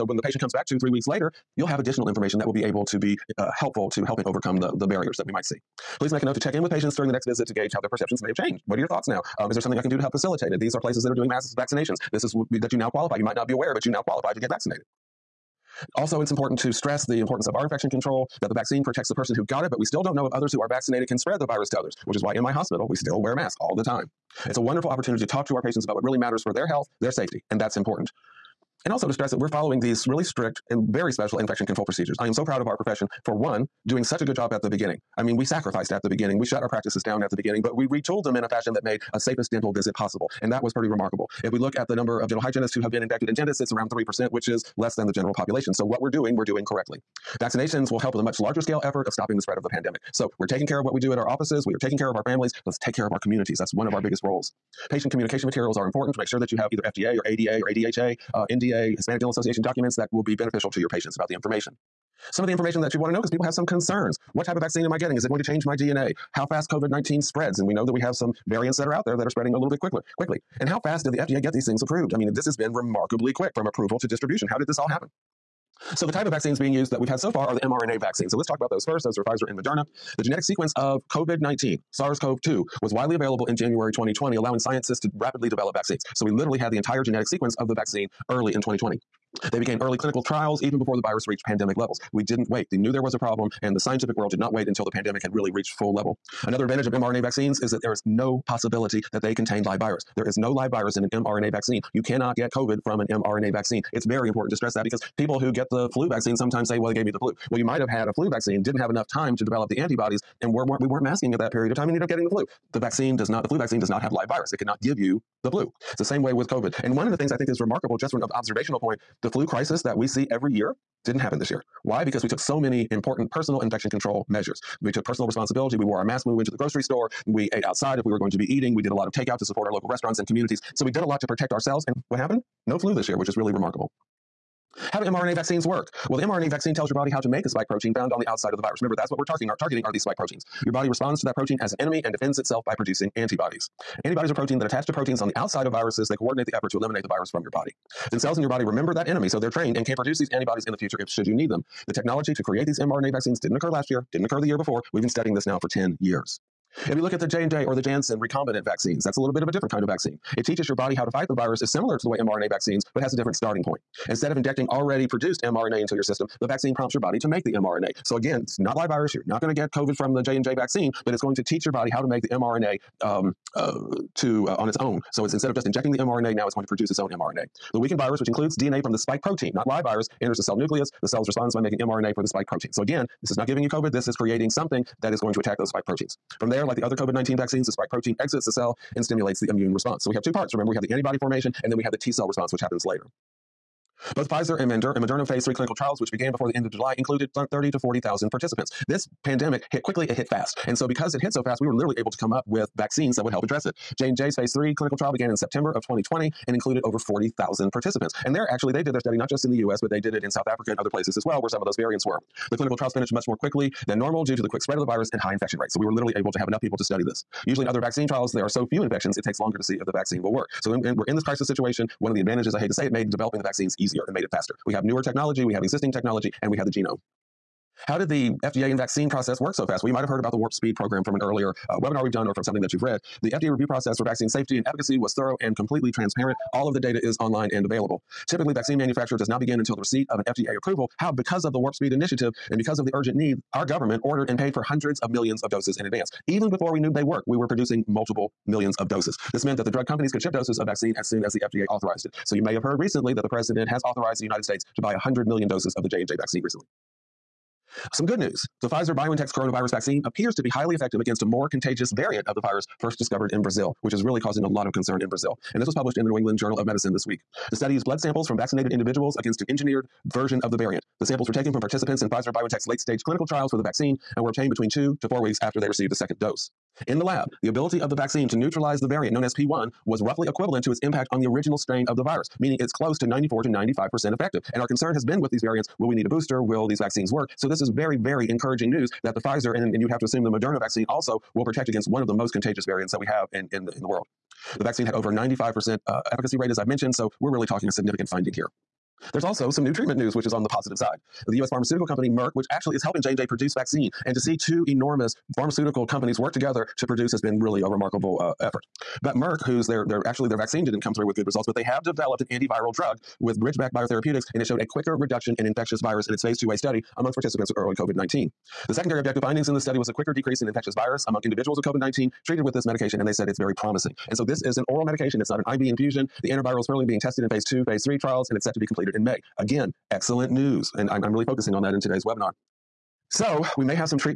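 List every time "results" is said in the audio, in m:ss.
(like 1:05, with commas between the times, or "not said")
5:11.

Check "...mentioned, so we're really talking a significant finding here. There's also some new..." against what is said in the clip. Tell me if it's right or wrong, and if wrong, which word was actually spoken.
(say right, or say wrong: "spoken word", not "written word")
right.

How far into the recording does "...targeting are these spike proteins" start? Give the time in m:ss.
2:19.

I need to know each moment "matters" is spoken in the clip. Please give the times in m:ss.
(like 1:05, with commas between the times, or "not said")
0:26.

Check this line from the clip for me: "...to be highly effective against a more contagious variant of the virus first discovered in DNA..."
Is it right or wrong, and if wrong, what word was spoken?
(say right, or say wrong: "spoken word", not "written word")
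wrong: "Brazil", not "DNA".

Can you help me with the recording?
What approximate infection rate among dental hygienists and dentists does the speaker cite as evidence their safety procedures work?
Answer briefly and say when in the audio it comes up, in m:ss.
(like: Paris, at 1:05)
3%, at 0:43.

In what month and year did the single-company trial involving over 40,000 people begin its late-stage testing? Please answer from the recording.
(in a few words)
September 2020.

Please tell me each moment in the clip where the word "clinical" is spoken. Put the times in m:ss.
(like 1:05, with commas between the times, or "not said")
1:29, 3:15, 3:24, 3:32, 4:33.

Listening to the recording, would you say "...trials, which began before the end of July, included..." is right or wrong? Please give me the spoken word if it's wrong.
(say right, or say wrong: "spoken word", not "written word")
right.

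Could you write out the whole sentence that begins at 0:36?
We shut our practices down at the beginning, but we retooled them in a fashion that made a safest dental visit possible.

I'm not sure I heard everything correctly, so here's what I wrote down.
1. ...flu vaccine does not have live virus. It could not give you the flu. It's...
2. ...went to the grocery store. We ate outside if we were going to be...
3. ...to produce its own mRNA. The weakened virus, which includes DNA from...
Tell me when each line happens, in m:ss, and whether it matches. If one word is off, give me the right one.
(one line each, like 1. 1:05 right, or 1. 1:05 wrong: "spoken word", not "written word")
1. 1:53 right
2. 2:06 right
3. 2:56 right.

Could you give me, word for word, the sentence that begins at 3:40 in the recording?
So we're in this crisis situation.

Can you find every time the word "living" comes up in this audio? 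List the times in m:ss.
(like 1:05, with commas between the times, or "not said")
not said.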